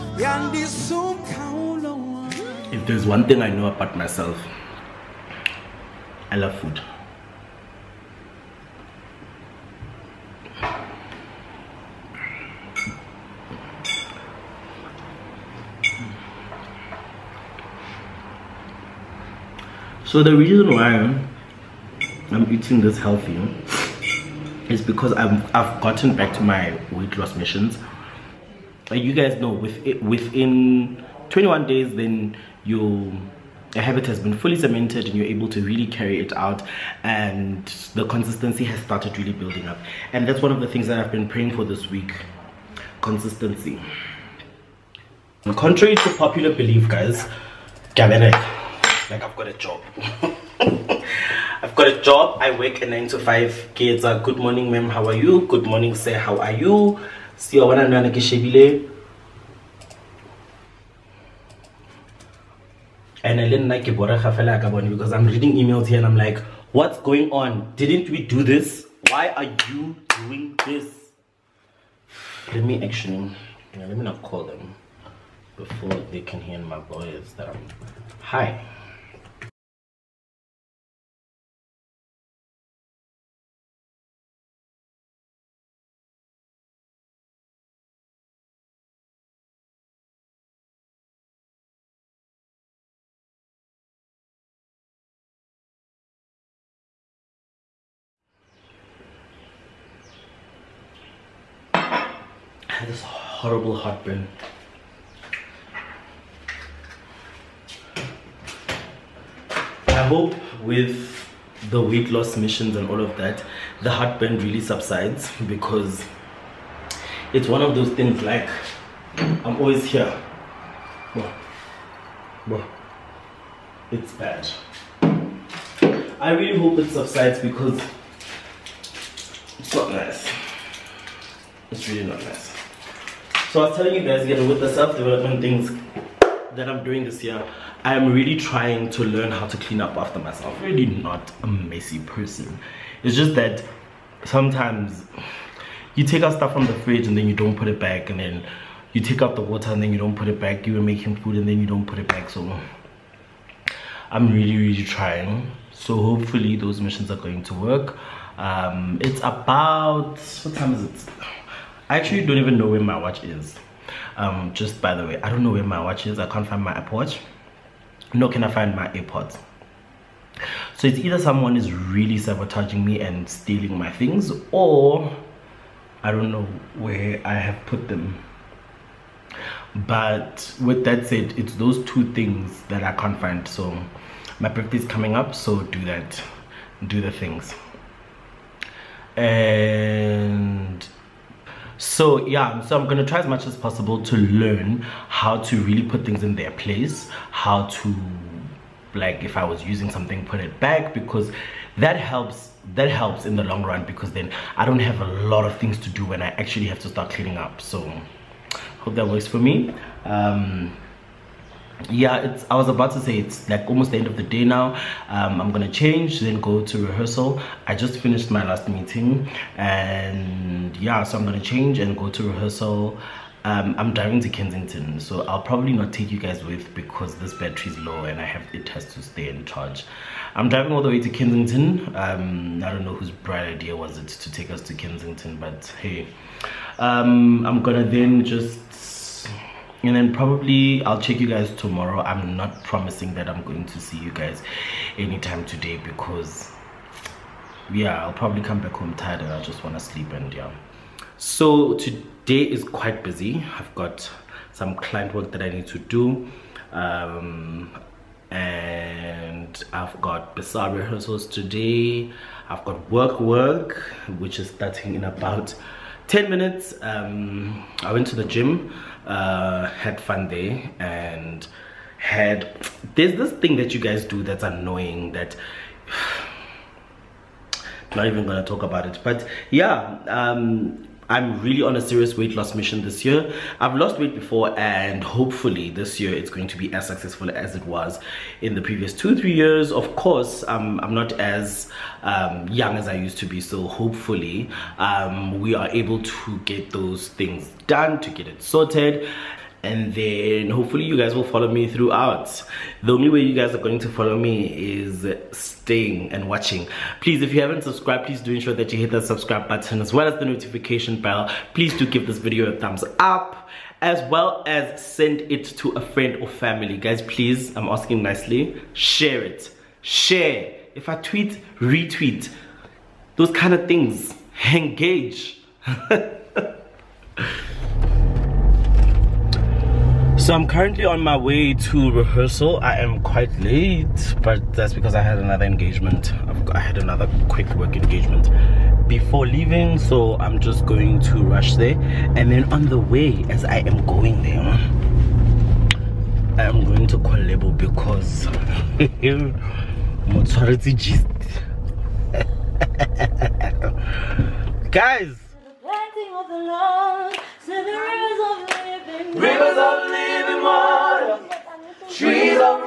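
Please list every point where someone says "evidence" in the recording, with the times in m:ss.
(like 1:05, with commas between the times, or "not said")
not said.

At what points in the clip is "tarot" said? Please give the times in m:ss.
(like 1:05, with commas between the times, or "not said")
not said.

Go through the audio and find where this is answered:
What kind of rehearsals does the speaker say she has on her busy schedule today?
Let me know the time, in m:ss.
4:20.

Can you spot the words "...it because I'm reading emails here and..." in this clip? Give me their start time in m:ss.
1:03.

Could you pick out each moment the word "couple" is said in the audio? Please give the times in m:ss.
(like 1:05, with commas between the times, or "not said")
not said.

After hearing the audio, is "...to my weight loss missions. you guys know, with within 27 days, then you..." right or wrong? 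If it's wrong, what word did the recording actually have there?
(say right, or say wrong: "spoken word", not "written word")
wrong: "21", not "27".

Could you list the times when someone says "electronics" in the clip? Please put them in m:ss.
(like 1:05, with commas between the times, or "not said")
not said.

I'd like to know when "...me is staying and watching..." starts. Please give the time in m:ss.
5:04.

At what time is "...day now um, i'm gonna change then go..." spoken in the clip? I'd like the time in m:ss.
3:34.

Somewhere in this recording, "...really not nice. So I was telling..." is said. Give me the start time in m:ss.
2:11.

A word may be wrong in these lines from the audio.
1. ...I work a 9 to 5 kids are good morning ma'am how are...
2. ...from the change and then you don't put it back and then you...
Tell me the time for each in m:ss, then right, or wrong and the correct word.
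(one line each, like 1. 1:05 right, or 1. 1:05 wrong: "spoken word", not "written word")
1. 0:52 right
2. 2:26 wrong: "fridge", not "change".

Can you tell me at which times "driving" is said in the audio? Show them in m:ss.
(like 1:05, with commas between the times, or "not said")
3:43, 3:50.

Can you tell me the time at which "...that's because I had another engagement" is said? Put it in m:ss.
5:34.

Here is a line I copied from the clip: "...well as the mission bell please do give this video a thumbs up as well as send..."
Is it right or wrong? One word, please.
wrong.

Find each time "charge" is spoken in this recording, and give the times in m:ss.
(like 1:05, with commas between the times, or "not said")
3:49.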